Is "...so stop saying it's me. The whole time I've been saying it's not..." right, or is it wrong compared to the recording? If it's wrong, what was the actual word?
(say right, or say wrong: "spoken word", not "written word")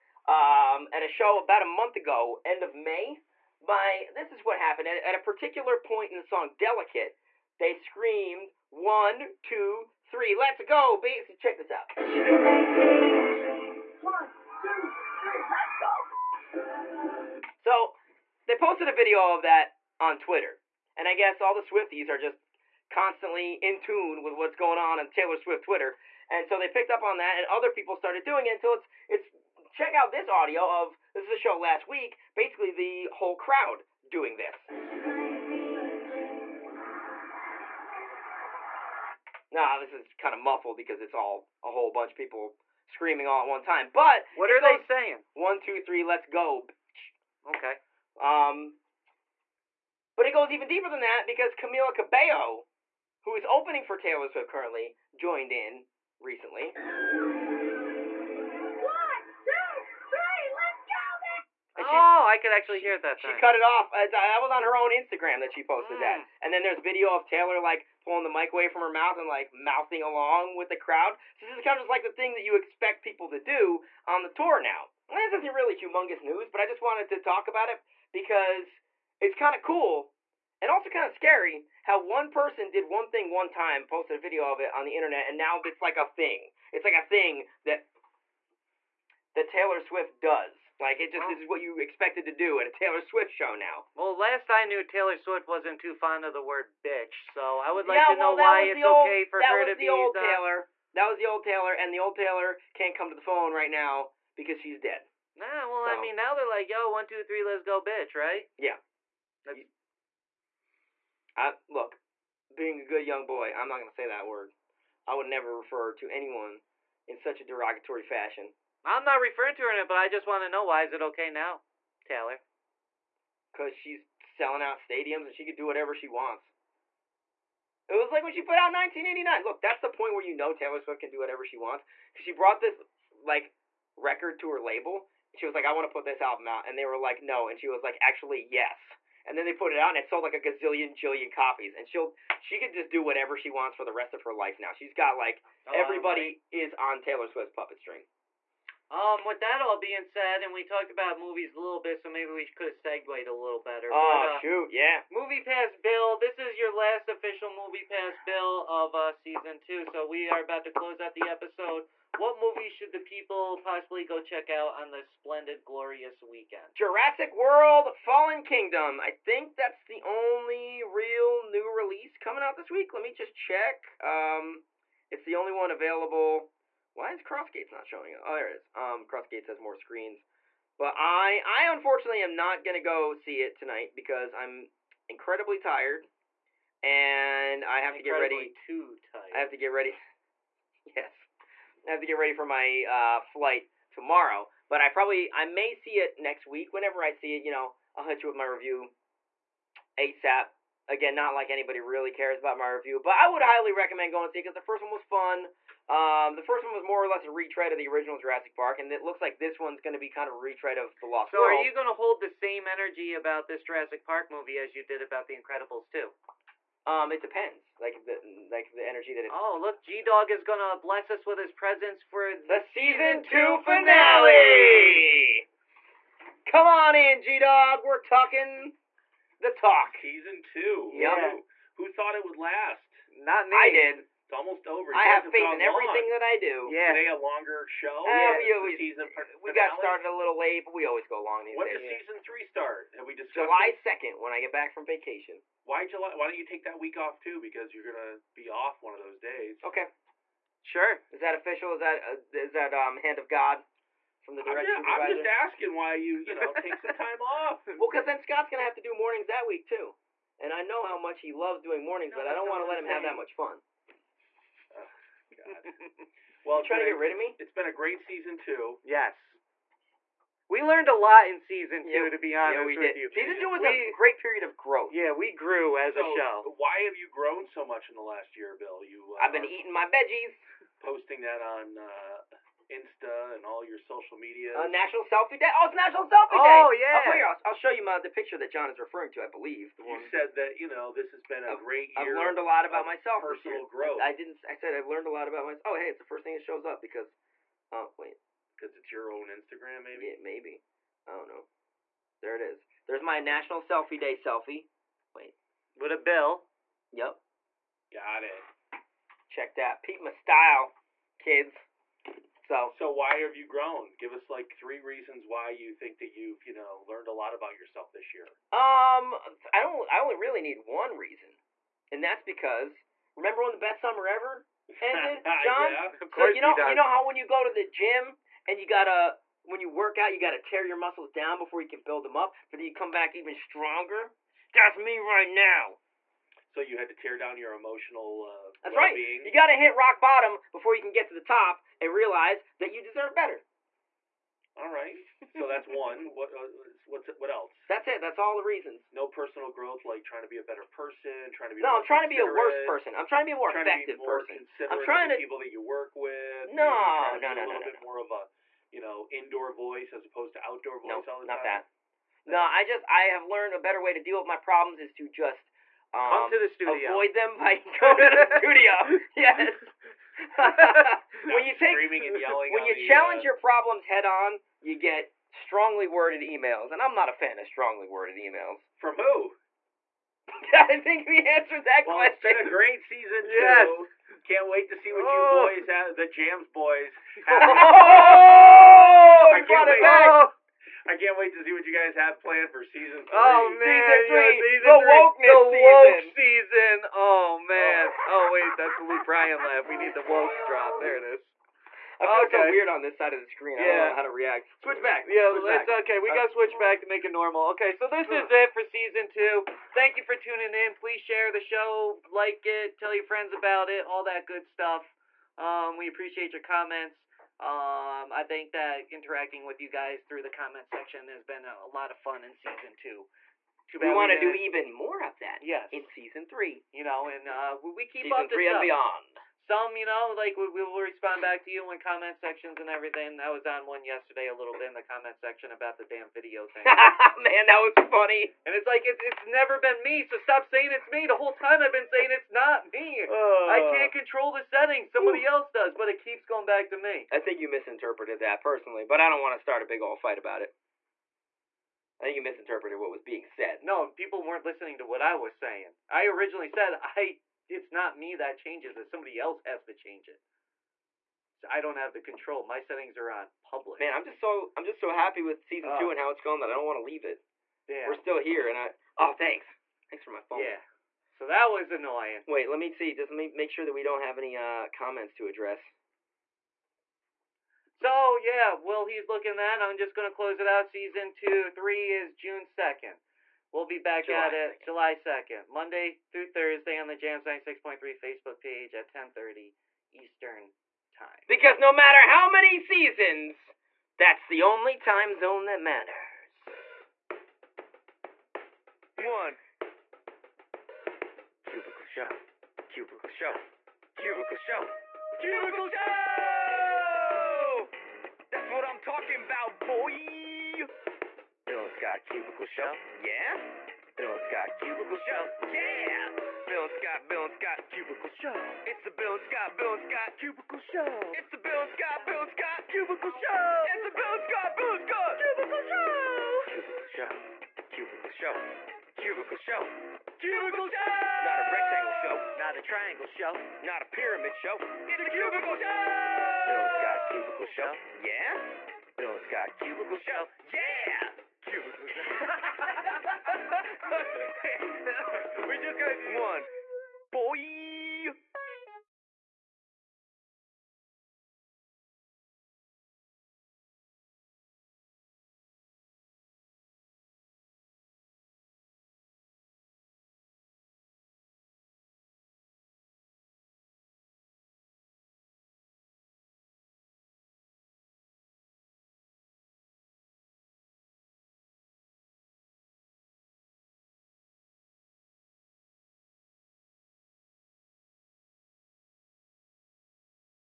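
right.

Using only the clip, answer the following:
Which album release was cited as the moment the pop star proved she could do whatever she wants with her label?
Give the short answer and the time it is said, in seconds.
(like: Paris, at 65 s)
1989, at 128 s.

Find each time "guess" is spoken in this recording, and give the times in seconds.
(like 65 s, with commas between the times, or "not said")
21 s.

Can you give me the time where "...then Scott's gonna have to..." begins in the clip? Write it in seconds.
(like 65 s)
258 s.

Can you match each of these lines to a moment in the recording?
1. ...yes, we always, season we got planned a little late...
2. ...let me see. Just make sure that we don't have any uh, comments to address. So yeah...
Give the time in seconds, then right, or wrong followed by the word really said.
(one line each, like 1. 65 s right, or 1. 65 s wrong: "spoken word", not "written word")
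1. 238 s wrong: "started", not "planned"
2. 472 s right.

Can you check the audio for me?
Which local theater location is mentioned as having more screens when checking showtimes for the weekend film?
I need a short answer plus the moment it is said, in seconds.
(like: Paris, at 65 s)
Crossgates, at 179 s.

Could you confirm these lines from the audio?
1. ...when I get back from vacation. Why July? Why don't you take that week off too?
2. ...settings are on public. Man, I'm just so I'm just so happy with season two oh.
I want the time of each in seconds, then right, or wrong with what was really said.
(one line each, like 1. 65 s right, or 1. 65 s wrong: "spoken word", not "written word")
1. 244 s right
2. 462 s right.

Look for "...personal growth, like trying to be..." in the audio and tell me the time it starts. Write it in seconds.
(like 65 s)
349 s.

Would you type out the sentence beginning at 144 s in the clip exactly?
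She's got like oh, everybody right.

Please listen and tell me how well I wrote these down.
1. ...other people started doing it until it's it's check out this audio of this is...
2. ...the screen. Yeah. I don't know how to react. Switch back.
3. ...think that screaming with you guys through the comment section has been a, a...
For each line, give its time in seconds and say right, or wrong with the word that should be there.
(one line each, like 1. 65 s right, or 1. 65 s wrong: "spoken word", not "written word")
1. 27 s right
2. 403 s right
3. 418 s wrong: "interacting", not "screaming".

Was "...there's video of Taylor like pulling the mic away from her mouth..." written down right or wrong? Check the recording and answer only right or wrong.
right.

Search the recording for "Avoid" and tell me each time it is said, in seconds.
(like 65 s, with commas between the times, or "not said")
366 s.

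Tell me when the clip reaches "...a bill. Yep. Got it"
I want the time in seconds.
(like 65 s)
305 s.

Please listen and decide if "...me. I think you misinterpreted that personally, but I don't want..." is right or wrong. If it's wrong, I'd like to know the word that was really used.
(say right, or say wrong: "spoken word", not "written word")
right.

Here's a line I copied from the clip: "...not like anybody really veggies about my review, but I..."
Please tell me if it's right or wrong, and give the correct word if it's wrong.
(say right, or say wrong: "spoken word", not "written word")
wrong: "cares", not "veggies".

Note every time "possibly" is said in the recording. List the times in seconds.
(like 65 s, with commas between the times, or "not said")
163 s.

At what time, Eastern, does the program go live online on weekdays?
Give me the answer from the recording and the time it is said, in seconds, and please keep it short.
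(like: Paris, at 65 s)
10:30, at 488 s.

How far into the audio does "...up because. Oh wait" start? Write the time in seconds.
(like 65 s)
296 s.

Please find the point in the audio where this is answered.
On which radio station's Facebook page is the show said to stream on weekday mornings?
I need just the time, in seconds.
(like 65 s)
486 s.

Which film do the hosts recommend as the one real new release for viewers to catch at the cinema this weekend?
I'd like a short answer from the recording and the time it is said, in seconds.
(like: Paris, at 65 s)
Jurassic World: Fallen Kingdom, at 166 s.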